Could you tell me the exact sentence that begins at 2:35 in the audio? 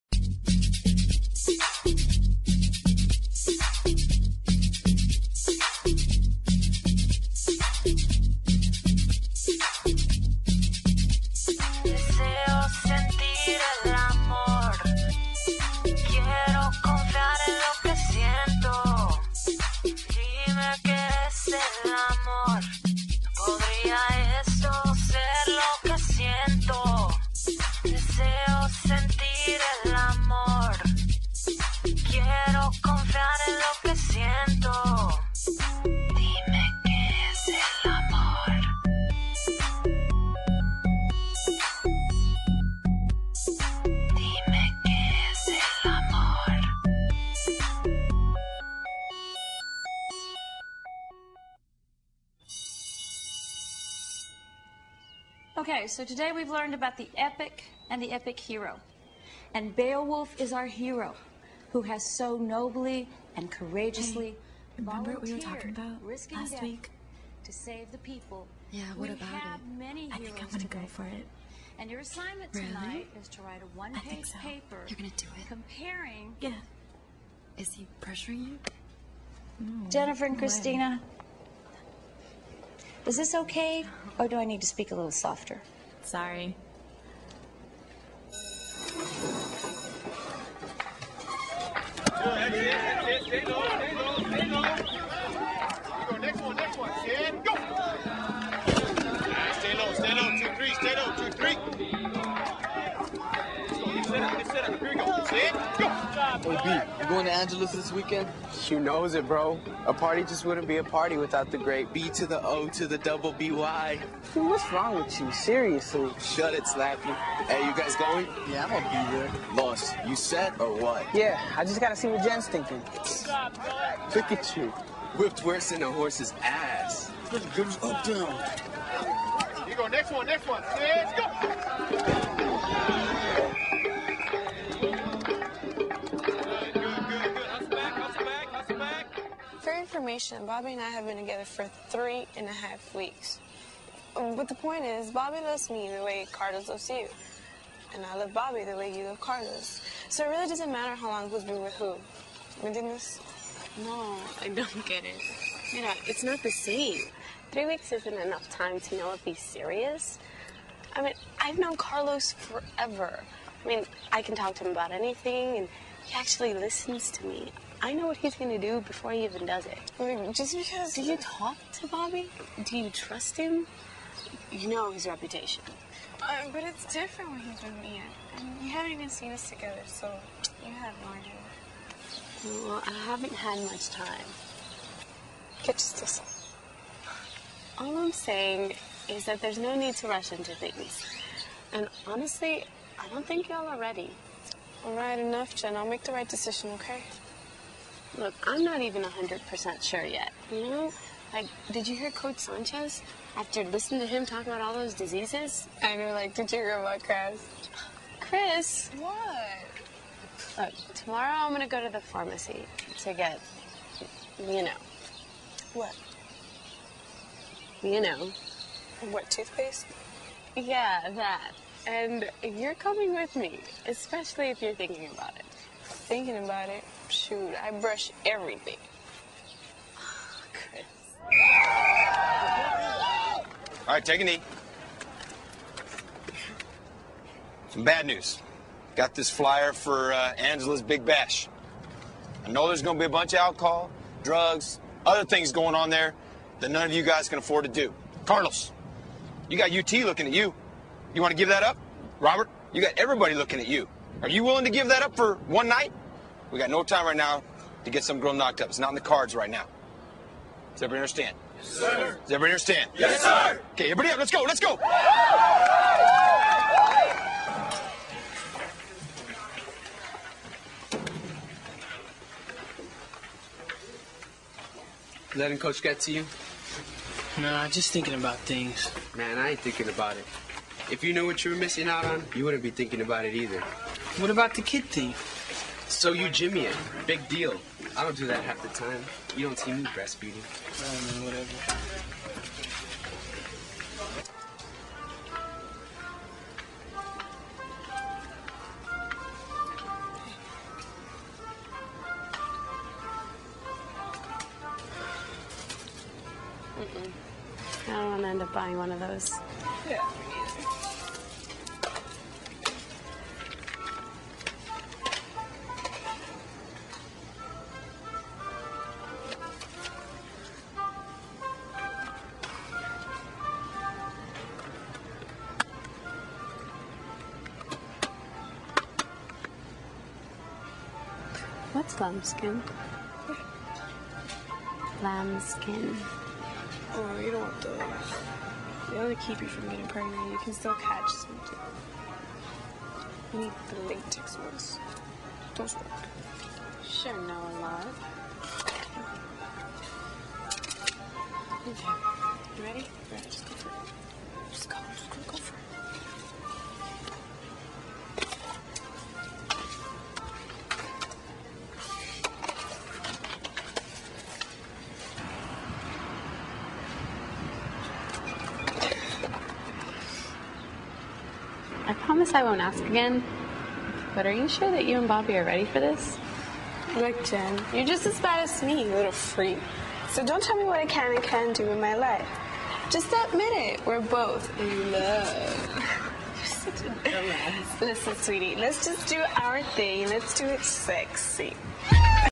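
You know, it's not the same.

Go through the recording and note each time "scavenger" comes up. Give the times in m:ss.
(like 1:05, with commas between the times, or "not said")
not said.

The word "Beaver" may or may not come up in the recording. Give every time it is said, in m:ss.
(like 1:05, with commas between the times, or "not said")
not said.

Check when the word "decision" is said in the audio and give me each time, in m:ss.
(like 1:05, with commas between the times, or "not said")
3:16.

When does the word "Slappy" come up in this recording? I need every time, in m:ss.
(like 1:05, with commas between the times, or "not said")
1:56.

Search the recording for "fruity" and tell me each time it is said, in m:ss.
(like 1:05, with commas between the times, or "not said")
not said.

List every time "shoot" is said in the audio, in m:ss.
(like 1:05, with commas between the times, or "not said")
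3:47.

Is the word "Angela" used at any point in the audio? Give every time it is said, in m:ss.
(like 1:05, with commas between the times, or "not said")
1:47, 4:00.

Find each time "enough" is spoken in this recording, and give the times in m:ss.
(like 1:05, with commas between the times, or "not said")
2:38, 3:15.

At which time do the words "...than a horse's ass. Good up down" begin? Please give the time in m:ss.
2:05.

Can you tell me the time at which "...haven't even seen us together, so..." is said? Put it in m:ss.
2:58.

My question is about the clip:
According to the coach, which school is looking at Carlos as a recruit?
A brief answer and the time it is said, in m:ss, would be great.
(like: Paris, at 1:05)
UT, at 4:09.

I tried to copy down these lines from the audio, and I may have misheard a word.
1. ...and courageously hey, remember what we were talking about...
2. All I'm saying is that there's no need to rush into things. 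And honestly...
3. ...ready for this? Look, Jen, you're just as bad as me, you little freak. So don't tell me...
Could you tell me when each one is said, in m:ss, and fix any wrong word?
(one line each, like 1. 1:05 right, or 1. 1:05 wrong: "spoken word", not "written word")
1. 1:03 right
2. 3:07 right
3. 6:15 right.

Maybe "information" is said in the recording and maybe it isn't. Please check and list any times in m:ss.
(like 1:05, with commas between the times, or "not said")
2:20.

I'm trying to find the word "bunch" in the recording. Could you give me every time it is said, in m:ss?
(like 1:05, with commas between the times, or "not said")
4:03.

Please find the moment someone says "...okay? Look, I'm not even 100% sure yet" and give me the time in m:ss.
3:16.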